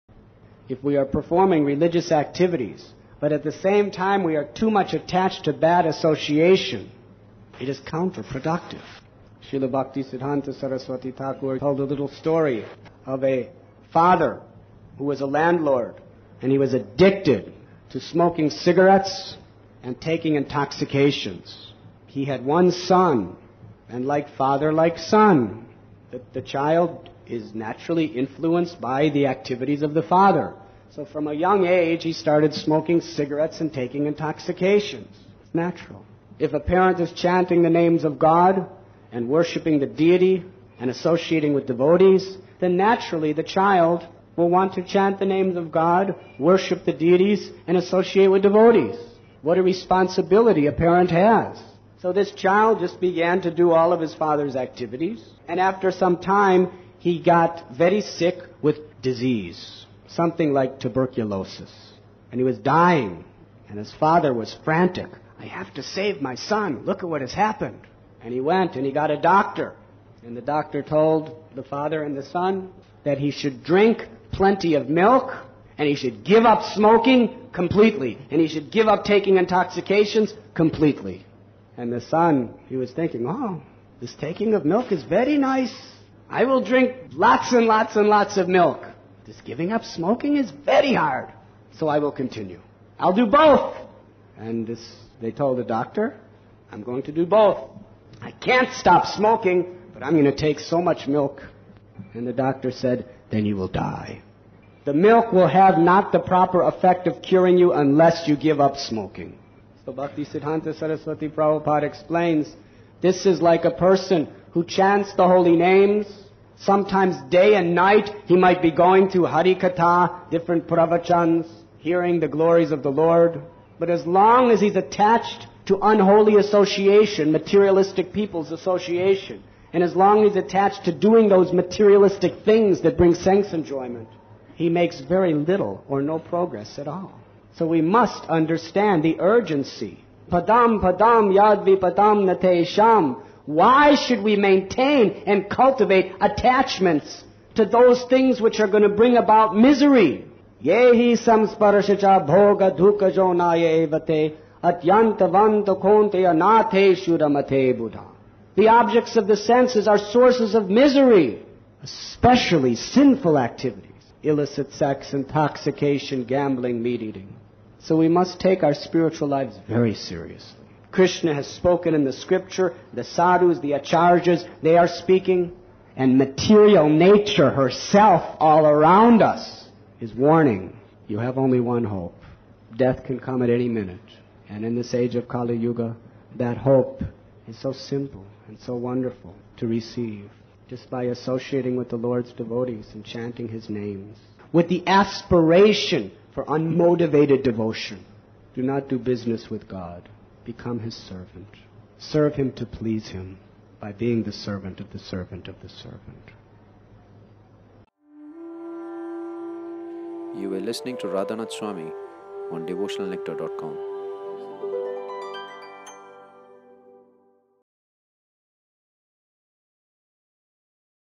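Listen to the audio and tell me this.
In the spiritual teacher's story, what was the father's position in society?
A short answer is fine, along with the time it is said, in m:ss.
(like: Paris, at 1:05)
Landlord, at 0:15.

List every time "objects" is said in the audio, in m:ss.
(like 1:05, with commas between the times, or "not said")
2:38.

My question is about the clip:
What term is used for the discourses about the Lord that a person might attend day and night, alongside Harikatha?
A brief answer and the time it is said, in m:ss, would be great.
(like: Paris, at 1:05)
Pravachans, at 2:00.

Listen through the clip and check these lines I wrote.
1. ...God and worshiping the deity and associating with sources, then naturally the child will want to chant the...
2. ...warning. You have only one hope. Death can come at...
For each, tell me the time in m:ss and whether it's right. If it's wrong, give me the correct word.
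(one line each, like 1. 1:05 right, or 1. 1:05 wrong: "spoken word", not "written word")
1. 0:38 wrong: "devotees", not "sources"
2. 3:00 right.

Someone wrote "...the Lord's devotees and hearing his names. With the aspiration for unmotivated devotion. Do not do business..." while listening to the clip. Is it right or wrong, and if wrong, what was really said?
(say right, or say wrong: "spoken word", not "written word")
wrong: "chanting", not "hearing".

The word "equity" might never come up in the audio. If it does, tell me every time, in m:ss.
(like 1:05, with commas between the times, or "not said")
not said.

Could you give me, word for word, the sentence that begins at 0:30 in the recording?
So from a young age, he started smoking cigarettes and taking intoxications.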